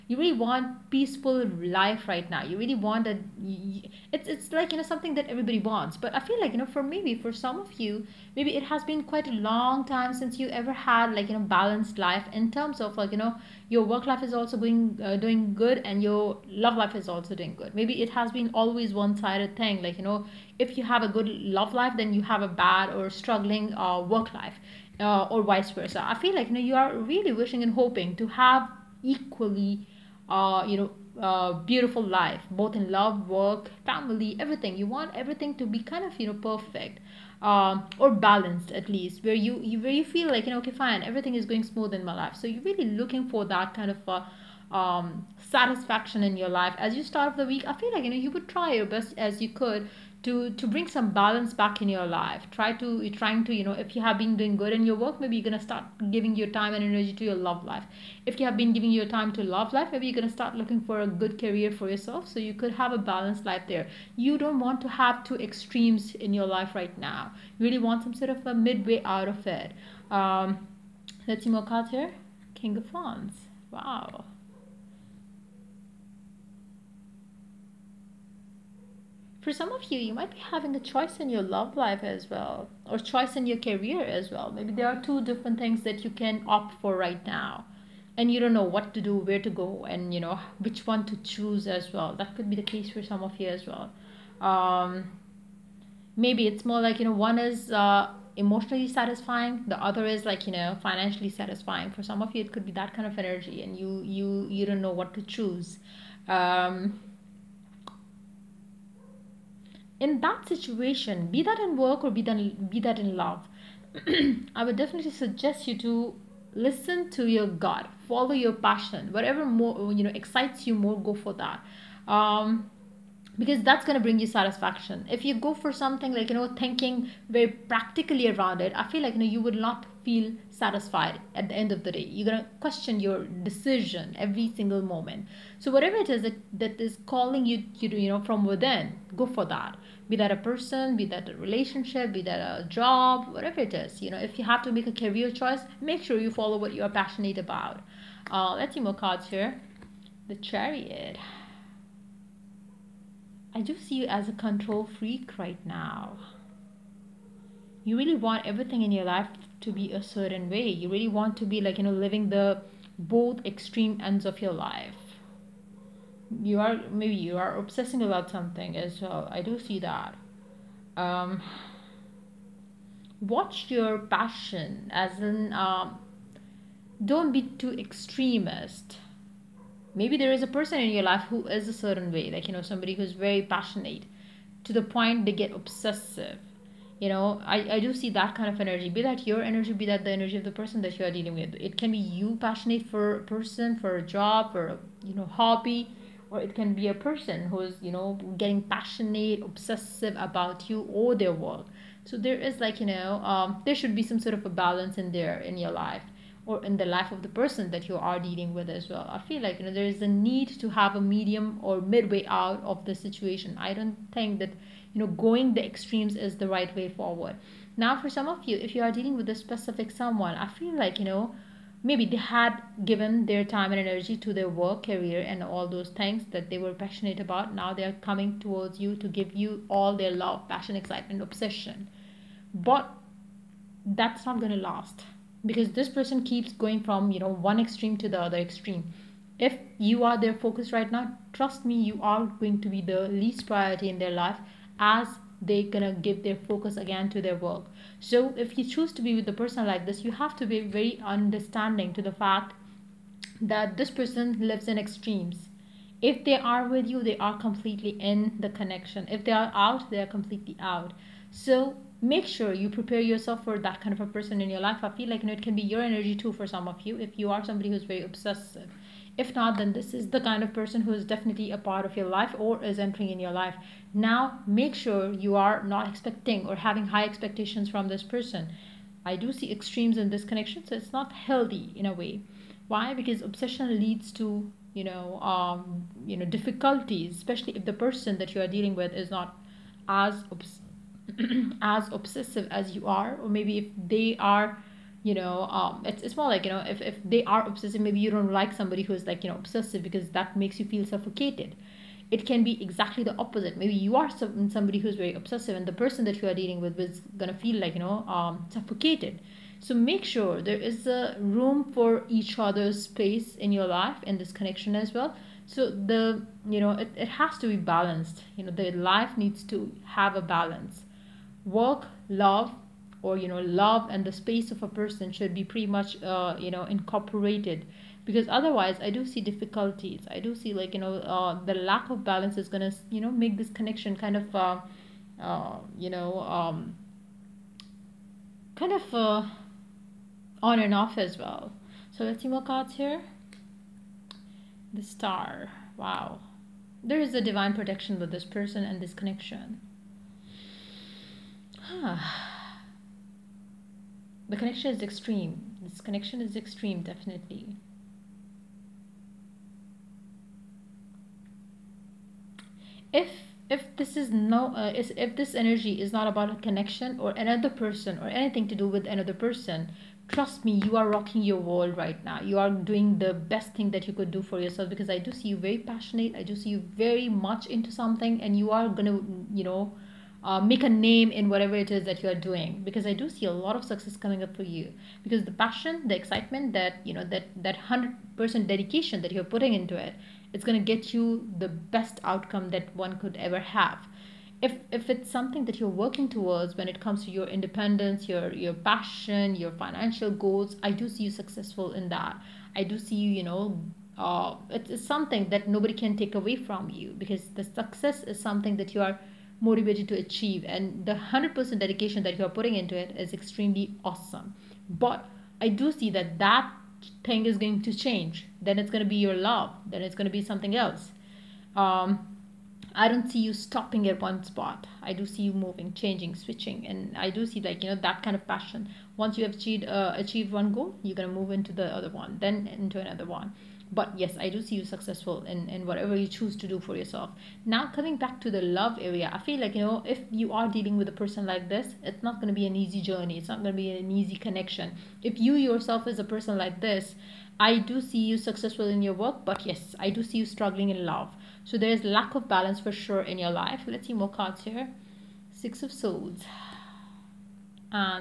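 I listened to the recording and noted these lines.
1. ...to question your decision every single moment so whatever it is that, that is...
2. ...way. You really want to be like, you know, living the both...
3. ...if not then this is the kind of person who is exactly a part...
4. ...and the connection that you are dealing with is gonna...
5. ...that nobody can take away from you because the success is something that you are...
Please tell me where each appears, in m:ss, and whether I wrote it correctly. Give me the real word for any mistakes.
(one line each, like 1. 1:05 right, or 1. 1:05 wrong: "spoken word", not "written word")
1. 2:12 right
2. 2:40 right
3. 4:29 wrong: "definitely", not "exactly"
4. 5:05 wrong: "person", not "connection"
5. 6:45 right.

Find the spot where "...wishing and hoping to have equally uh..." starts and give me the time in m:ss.
0:27.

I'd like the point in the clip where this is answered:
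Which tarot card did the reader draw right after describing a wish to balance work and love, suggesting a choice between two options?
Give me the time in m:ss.
1:12.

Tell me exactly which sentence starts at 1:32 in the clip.
That could be the case for some of you as well.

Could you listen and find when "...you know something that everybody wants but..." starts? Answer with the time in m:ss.
0:04.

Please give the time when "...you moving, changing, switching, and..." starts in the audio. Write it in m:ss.
7:05.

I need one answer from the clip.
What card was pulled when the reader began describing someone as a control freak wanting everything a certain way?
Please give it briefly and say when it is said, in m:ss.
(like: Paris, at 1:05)
The Chariot, at 2:30.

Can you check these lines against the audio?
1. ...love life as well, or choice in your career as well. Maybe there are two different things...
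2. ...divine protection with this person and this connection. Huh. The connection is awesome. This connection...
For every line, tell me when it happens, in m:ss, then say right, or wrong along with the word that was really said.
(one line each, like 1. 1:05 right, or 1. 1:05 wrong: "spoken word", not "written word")
1. 1:21 right
2. 5:47 wrong: "extreme", not "awesome".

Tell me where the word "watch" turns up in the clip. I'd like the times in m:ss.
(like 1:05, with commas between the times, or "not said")
2:53.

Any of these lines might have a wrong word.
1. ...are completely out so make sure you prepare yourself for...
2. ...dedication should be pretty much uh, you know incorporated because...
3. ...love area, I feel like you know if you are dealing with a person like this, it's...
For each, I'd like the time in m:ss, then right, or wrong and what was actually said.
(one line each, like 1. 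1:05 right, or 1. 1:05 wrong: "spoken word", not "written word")
1. 4:19 right
2. 5:24 wrong: "person", not "dedication"
3. 7:18 right.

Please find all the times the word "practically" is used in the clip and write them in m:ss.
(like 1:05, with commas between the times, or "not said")
2:07.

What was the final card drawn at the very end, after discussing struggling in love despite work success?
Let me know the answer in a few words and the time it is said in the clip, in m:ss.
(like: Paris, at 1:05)
Six of Swords, at 7:35.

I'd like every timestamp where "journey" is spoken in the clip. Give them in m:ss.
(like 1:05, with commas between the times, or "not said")
7:22.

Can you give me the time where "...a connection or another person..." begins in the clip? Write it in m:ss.
6:06.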